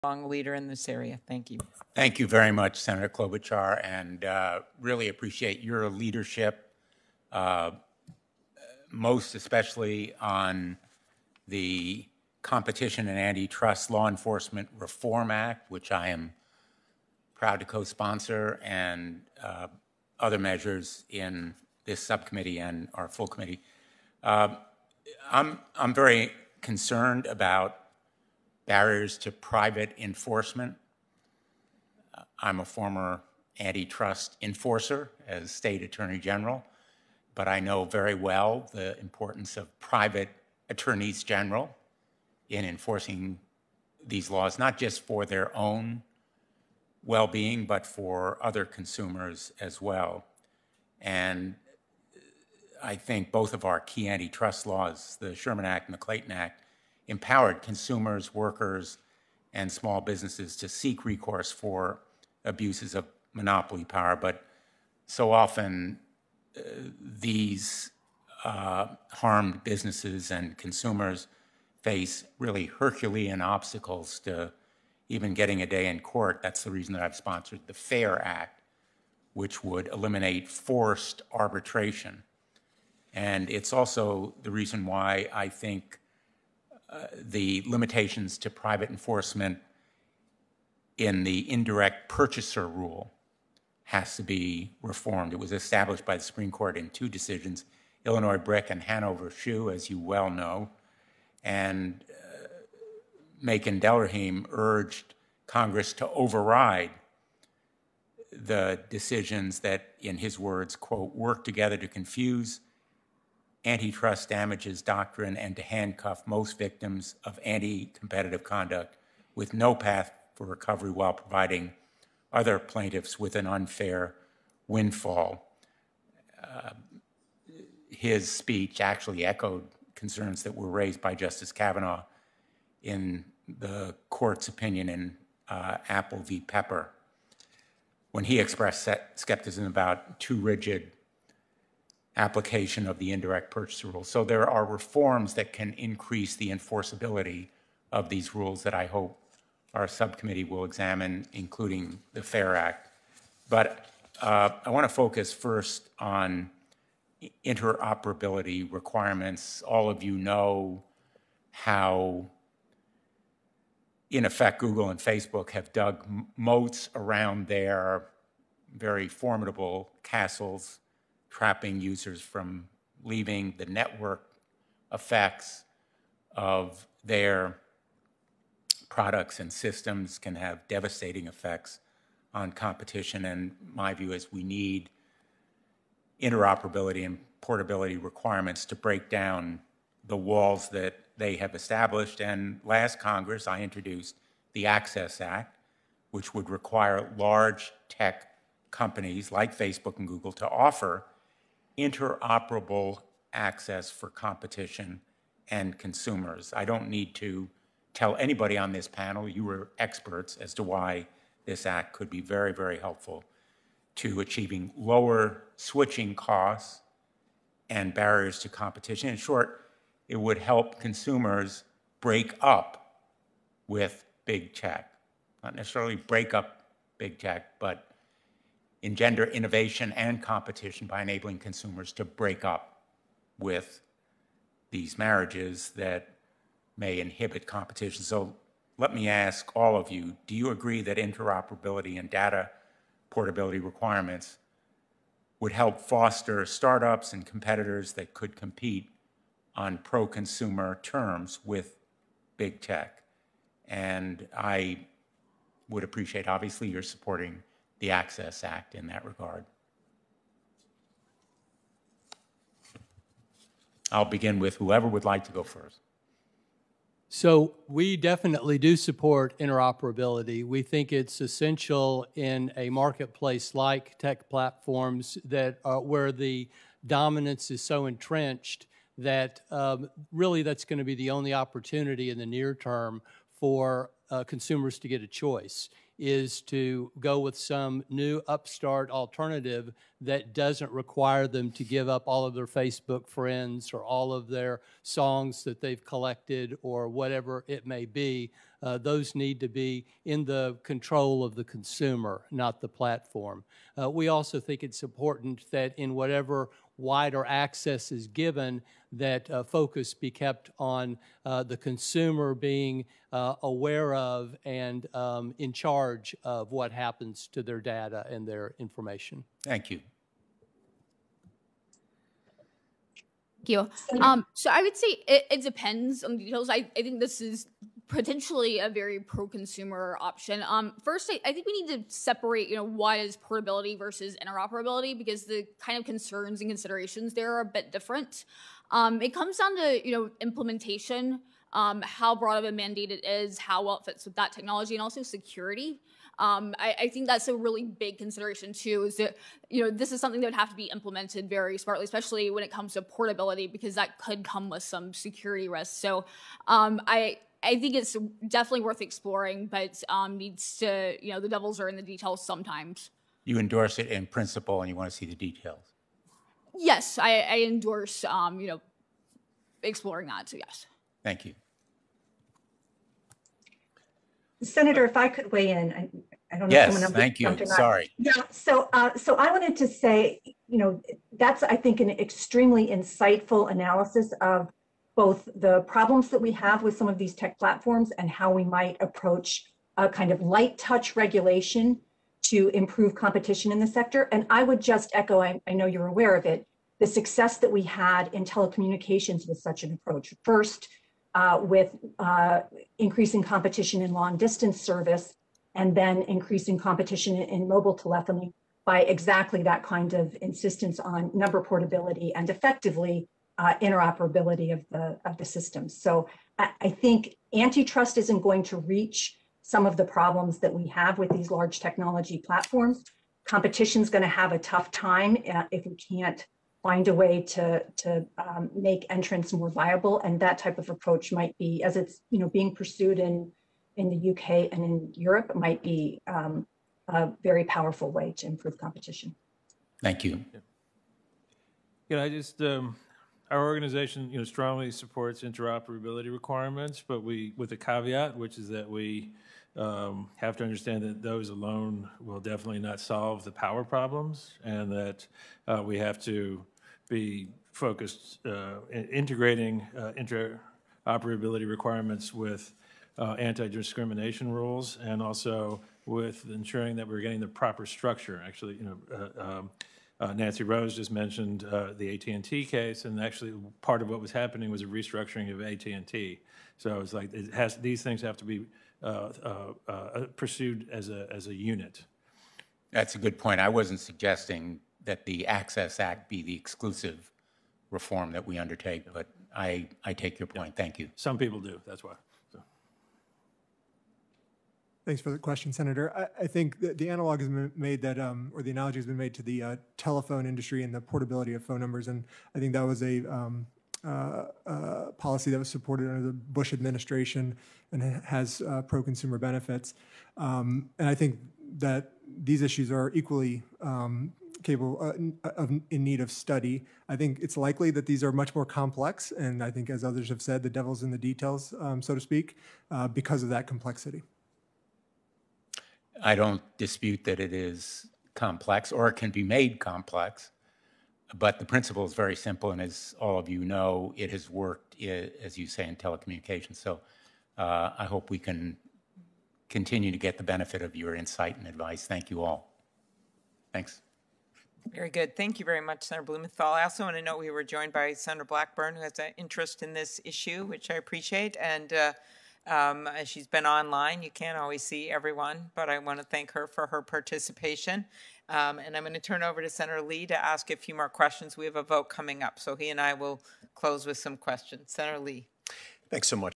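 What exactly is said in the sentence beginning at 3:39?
In short, it would help consumers break up with big tech.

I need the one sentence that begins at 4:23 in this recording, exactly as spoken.
I'll begin with whoever would like to go first.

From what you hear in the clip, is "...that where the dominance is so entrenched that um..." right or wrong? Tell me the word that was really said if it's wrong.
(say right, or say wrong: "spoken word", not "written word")
right.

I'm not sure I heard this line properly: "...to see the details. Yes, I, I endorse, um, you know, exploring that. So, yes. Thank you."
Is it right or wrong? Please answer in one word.
right.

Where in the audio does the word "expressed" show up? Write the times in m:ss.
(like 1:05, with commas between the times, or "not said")
2:18.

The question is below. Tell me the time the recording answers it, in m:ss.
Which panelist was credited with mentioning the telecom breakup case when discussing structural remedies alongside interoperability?
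7:50.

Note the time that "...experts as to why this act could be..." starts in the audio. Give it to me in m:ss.
3:29.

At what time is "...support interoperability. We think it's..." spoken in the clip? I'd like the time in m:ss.
4:28.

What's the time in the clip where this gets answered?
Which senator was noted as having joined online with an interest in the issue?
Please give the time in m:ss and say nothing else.
9:07.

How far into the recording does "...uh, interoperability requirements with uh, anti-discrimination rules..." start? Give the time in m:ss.
7:39.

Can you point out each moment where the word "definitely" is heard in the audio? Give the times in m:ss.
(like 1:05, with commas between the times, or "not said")
4:27, 5:58, 7:32.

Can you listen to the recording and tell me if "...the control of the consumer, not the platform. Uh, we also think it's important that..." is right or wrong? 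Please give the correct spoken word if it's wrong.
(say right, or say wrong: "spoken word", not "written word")
right.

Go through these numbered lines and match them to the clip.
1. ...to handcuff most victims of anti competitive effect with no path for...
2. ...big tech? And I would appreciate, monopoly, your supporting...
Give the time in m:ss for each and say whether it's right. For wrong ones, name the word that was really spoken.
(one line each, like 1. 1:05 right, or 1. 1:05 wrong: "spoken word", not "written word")
1. 1:55 wrong: "conduct", not "effect"
2. 4:12 wrong: "obviously", not "monopoly".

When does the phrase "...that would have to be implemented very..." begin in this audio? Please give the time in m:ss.
5:50.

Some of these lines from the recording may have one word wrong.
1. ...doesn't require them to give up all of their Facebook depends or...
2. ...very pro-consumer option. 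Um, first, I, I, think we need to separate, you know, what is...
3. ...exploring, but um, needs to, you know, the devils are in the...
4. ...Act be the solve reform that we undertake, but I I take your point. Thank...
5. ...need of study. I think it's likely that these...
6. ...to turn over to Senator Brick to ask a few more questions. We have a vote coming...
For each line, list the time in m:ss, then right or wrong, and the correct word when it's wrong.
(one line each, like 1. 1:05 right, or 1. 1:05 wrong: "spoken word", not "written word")
1. 4:50 wrong: "friends", not "depends"
2. 5:28 right
3. 5:58 right
4. 8:05 wrong: "exclusive", not "solve"
5. 8:35 right
6. 9:18 wrong: "Lee", not "Brick".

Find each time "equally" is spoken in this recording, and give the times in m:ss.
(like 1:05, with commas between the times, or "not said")
8:32.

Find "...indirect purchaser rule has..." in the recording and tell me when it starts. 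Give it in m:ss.
1:31.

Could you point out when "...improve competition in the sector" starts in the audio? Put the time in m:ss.
6:32.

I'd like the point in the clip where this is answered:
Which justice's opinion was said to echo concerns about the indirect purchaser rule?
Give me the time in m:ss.
2:11.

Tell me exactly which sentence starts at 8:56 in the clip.
So uh, I hope we can continue to get the benefit of your insight and advice.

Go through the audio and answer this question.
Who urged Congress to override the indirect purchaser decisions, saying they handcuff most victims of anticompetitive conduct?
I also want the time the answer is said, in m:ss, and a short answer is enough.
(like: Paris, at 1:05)
Makan Delrahim, at 1:43.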